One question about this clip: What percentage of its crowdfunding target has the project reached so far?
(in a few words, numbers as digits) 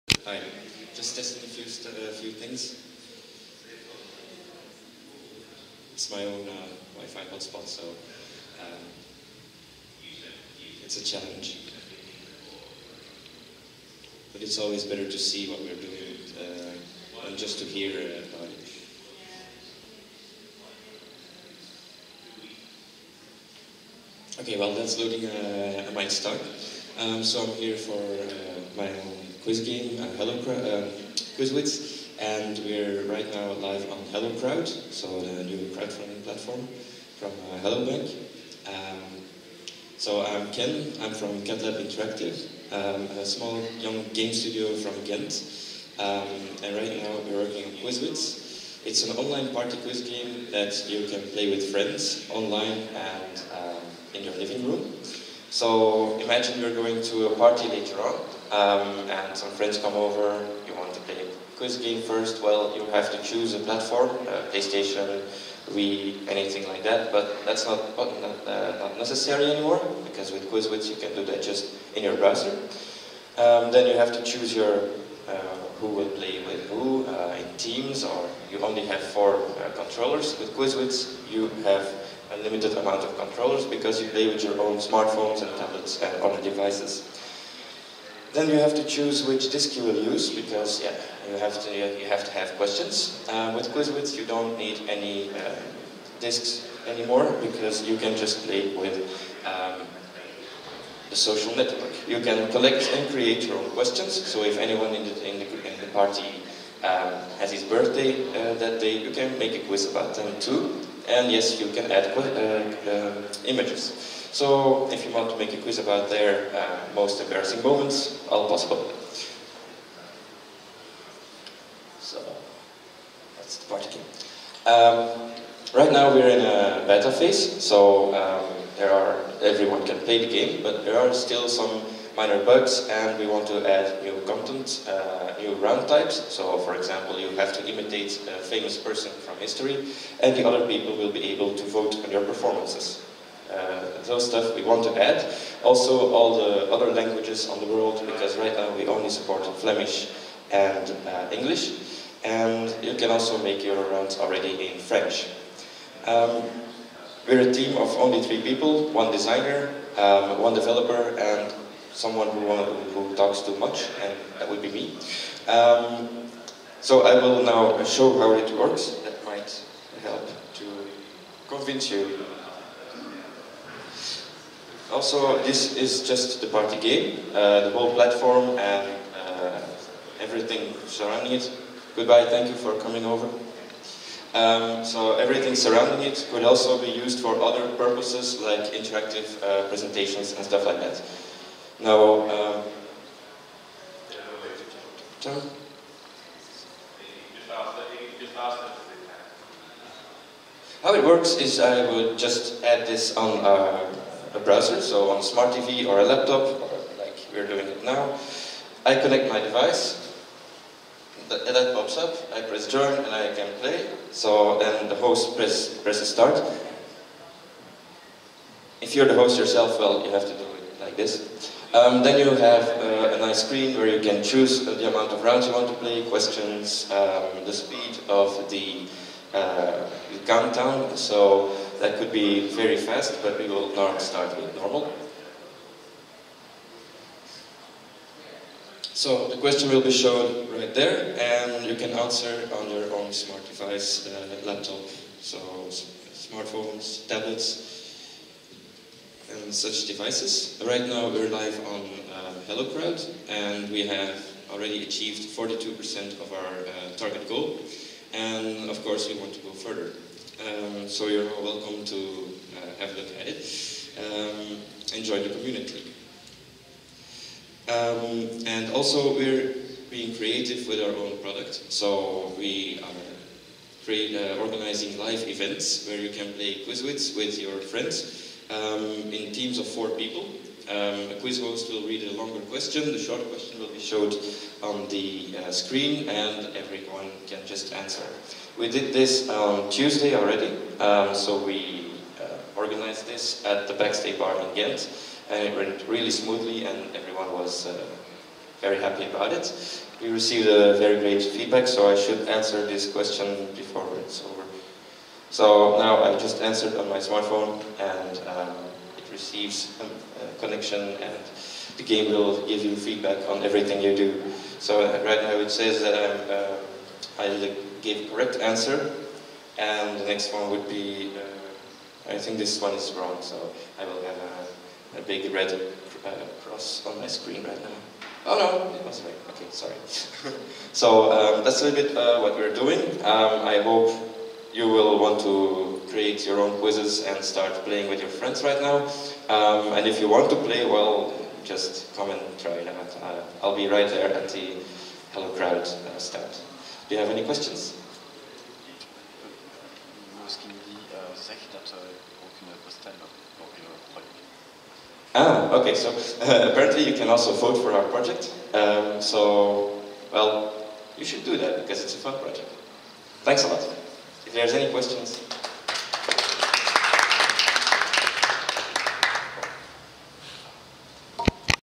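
42%.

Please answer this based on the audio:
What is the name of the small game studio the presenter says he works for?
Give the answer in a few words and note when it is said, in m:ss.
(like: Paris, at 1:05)
CatLab Interactive, at 0:41.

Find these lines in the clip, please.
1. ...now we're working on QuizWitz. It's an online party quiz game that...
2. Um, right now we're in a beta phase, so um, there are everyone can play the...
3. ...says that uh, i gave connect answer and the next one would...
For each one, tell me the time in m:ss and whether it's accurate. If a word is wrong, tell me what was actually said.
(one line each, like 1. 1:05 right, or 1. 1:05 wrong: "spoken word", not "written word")
1. 0:47 right
2. 2:04 right
3. 5:15 wrong: "correct", not "connect".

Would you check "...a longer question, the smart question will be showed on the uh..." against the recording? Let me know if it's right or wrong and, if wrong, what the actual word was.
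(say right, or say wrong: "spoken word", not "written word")
wrong: "short", not "smart".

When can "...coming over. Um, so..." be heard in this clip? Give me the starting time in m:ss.
3:02.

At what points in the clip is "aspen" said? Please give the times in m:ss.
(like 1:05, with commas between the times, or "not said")
not said.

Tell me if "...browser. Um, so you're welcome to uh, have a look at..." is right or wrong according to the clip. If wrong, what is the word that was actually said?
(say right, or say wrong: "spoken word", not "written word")
wrong: "further", not "browser".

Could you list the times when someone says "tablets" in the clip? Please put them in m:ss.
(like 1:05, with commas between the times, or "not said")
1:25, 4:07.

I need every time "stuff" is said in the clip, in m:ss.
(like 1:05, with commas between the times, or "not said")
2:24, 3:10.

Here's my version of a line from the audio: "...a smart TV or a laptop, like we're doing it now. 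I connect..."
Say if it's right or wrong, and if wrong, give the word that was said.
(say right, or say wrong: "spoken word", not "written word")
right.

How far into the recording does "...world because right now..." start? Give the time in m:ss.
2:27.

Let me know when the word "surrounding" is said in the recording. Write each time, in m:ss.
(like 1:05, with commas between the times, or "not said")
3:00, 3:05.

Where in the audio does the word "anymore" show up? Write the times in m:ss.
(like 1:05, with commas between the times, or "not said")
1:09, 1:36.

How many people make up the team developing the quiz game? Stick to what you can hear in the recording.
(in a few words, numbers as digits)
3.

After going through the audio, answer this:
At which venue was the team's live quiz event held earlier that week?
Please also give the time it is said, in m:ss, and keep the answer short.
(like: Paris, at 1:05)
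Backstay Bar, at 4:53.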